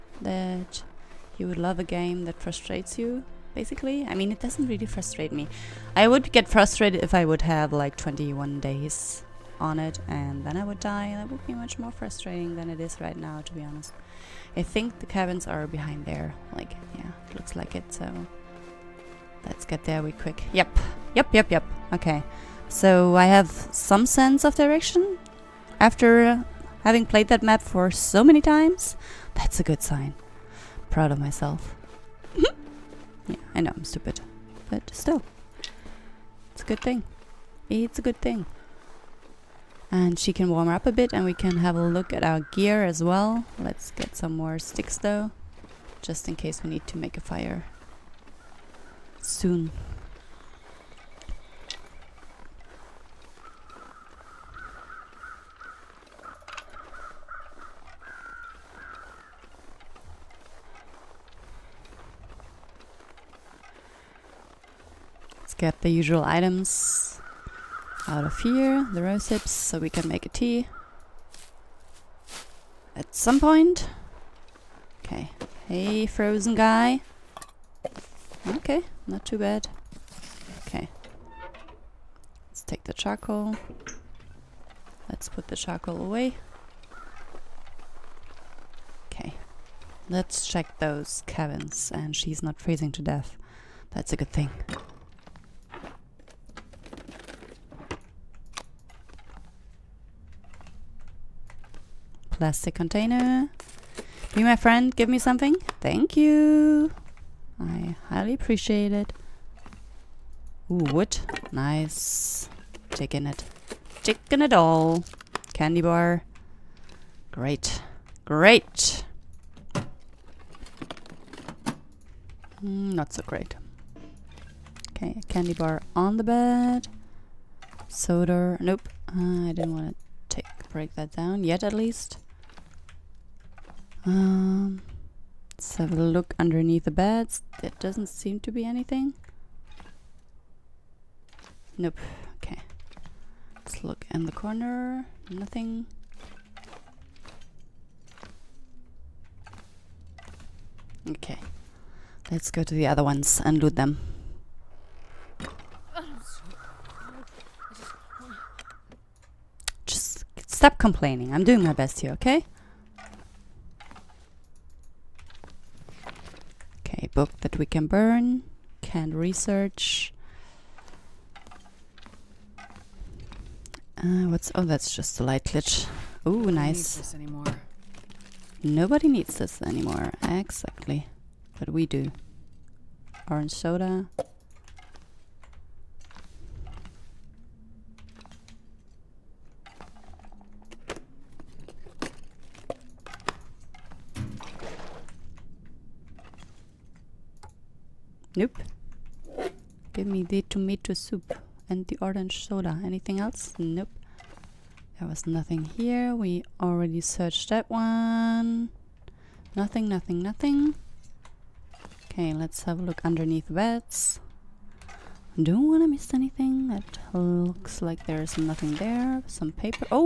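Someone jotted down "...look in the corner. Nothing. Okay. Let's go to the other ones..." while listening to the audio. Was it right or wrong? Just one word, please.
right.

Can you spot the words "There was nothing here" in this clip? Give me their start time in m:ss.
3:24.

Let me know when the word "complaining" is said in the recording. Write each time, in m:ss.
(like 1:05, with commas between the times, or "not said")
2:40.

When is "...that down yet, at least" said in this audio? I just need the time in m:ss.
2:10.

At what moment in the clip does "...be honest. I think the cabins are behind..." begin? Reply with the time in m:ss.
0:13.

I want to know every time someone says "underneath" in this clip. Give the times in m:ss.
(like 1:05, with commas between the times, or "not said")
2:16, 3:33.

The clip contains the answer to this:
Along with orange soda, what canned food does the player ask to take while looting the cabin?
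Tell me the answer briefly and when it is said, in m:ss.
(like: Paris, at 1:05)
tomato soup, at 3:20.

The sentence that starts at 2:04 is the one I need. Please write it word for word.
Okay, candy bar on the bed.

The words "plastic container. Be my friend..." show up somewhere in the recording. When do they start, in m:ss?
1:42.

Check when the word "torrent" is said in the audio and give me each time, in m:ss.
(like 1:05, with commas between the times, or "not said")
not said.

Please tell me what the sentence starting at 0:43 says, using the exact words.
Let's get some more sticks though, just in case we need to make a fire soon.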